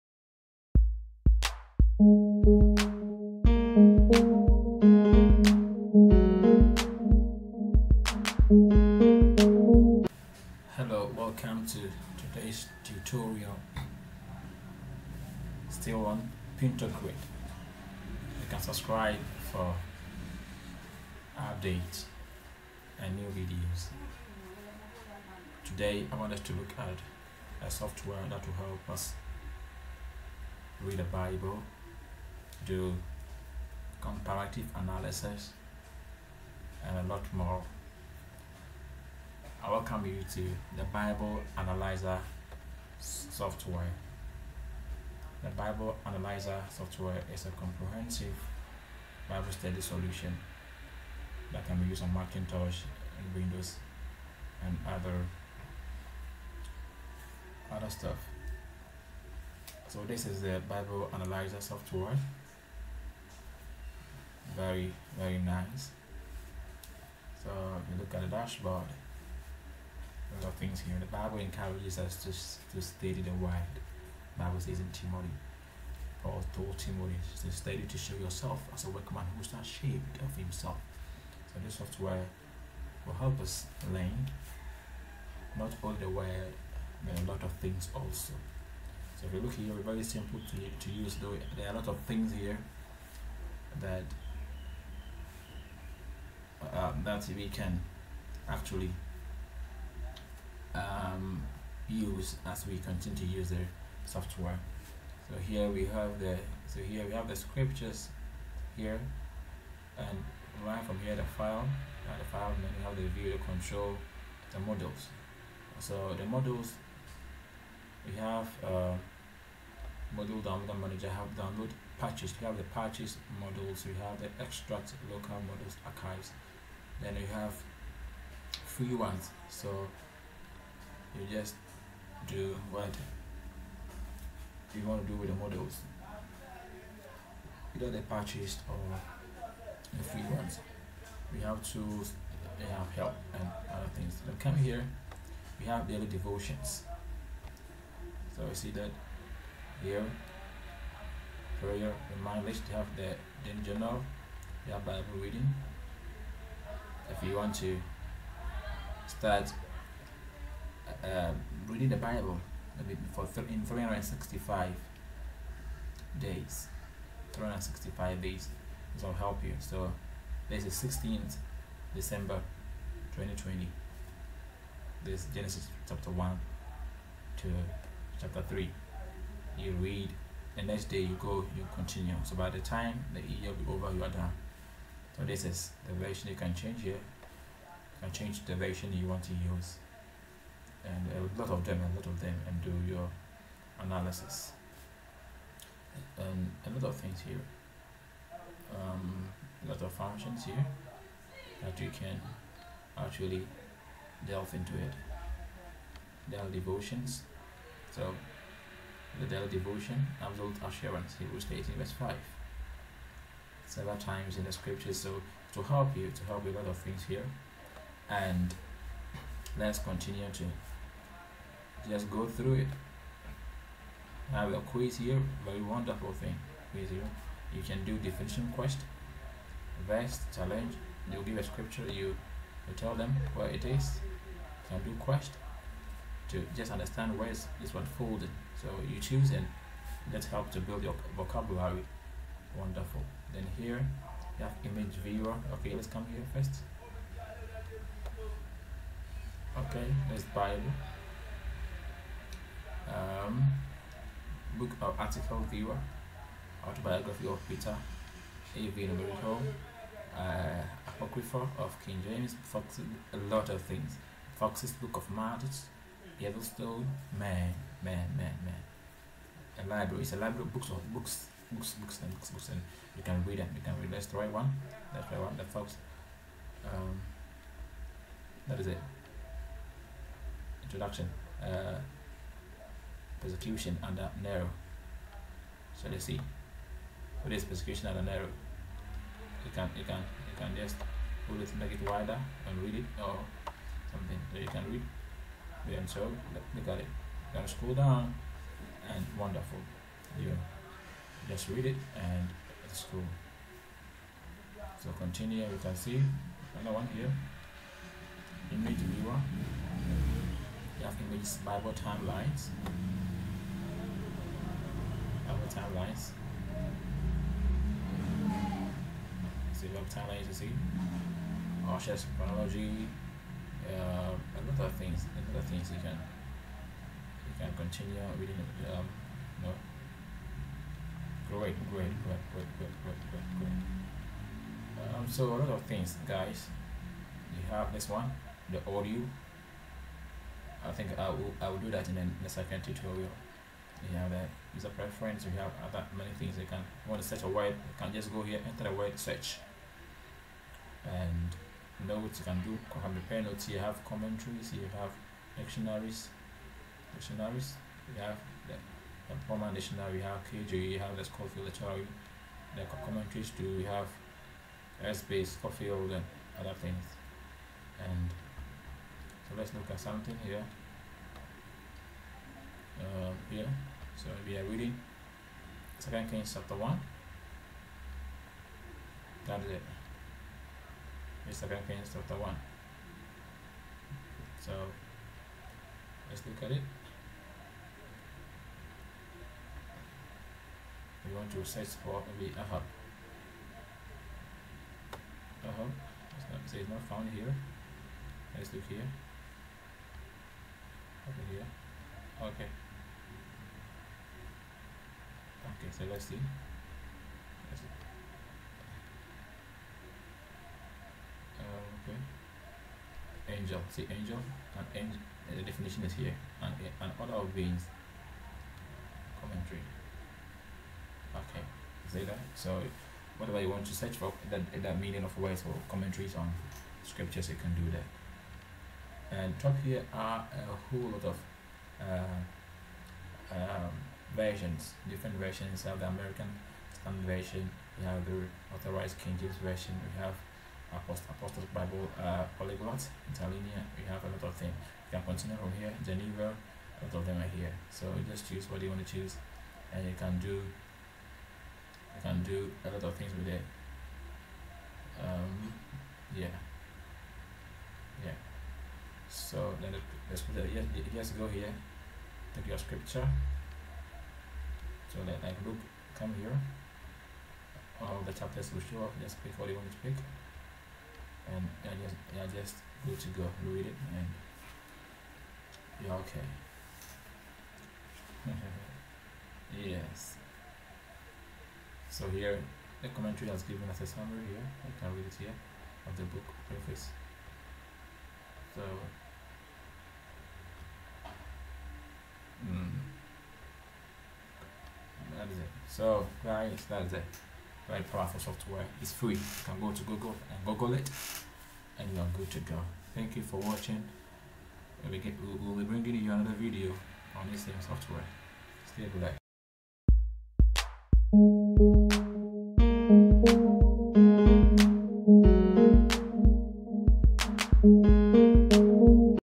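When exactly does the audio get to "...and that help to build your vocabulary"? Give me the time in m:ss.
3:59.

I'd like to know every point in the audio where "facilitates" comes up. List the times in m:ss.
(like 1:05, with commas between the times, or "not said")
not said.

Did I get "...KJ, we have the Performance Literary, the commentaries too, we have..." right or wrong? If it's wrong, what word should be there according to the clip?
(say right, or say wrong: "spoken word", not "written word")
wrong: "Scofield", not "Performance".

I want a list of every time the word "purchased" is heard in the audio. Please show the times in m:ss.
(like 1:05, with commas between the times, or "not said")
2:18.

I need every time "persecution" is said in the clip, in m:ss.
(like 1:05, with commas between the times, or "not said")
4:43, 4:47.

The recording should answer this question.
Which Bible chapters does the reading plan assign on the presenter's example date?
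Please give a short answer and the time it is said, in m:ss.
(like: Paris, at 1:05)
Genesis 1 to 3, at 2:55.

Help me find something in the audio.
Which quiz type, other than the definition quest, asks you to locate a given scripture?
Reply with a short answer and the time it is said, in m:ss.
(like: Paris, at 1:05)
verse challenge, at 3:49.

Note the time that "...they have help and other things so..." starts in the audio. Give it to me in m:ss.
2:22.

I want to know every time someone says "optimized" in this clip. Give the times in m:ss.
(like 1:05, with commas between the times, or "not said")
not said.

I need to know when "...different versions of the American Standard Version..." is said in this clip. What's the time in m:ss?
7:14.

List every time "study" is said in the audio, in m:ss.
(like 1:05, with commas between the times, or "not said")
0:49, 1:12, 1:17.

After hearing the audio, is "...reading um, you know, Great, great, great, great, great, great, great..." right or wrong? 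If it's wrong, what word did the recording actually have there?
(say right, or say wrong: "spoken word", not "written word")
right.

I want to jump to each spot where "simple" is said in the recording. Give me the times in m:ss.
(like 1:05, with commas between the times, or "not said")
1:30.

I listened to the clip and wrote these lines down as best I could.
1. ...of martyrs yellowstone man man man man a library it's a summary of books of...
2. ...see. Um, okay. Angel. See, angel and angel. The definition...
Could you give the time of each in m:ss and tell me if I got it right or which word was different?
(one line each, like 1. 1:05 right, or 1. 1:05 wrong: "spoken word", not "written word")
1. 4:24 wrong: "library", not "summary"
2. 6:47 right.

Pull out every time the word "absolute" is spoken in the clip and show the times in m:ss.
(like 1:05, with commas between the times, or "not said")
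3:30.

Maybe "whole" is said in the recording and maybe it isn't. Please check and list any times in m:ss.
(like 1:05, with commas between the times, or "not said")
7:10.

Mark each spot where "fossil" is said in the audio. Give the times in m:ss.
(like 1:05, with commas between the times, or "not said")
not said.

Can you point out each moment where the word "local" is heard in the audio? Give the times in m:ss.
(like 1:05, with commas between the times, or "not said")
2:05.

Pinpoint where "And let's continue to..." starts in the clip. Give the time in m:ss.
3:38.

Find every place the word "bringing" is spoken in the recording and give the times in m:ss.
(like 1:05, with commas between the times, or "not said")
8:25.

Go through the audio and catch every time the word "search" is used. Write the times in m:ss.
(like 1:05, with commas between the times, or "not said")
5:48, 6:31, 7:03.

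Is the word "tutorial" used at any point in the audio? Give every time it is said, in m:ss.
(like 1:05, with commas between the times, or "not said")
0:12, 5:42.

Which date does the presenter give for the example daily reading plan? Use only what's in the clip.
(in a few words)
16th December 2020.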